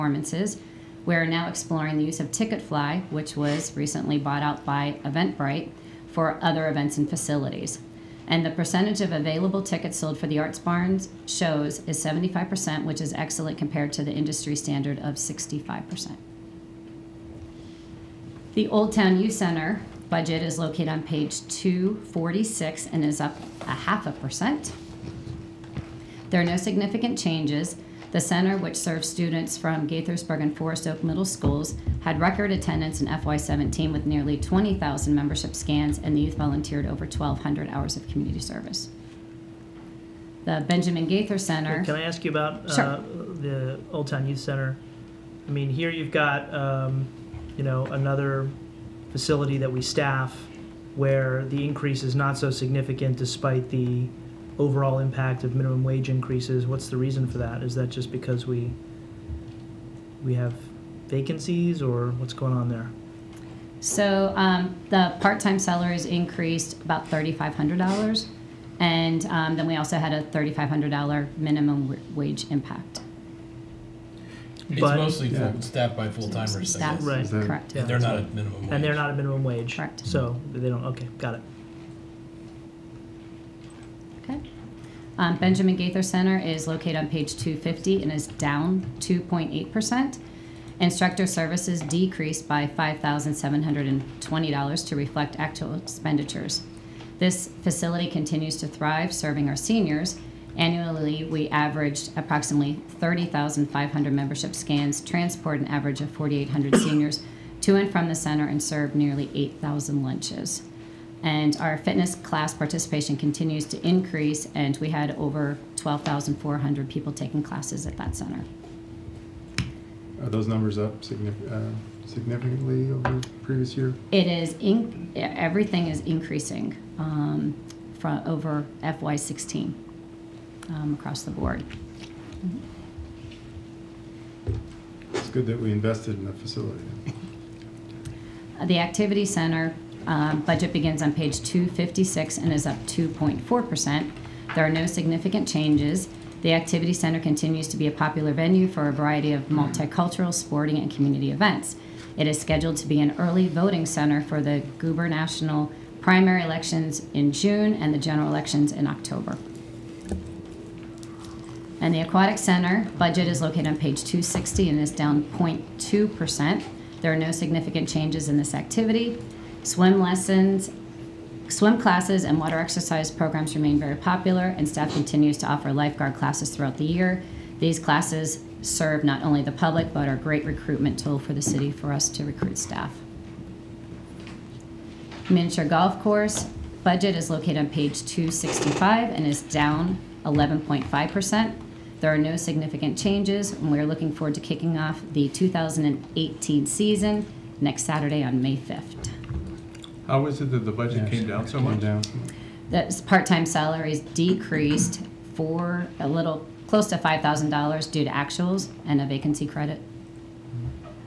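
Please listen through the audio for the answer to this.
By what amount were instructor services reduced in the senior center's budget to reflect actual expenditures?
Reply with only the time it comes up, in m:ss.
1:32.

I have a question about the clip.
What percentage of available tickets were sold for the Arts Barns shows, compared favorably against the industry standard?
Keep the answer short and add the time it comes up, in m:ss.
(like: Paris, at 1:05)
75%, at 0:12.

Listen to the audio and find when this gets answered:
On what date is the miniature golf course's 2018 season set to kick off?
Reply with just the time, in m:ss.
3:18.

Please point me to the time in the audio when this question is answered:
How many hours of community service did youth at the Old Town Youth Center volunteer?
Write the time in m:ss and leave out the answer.
0:37.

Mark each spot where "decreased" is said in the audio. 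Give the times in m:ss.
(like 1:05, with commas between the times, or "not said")
1:31, 3:23.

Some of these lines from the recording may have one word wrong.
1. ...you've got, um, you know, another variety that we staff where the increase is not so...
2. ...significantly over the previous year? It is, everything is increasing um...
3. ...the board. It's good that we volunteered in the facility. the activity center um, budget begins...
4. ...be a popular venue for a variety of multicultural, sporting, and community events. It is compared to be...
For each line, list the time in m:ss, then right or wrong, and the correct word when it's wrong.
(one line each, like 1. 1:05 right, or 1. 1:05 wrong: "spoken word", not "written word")
1. 0:45 wrong: "facility", not "variety"
2. 2:02 right
3. 2:11 wrong: "invested", not "volunteered"
4. 2:27 wrong: "scheduled", not "compared".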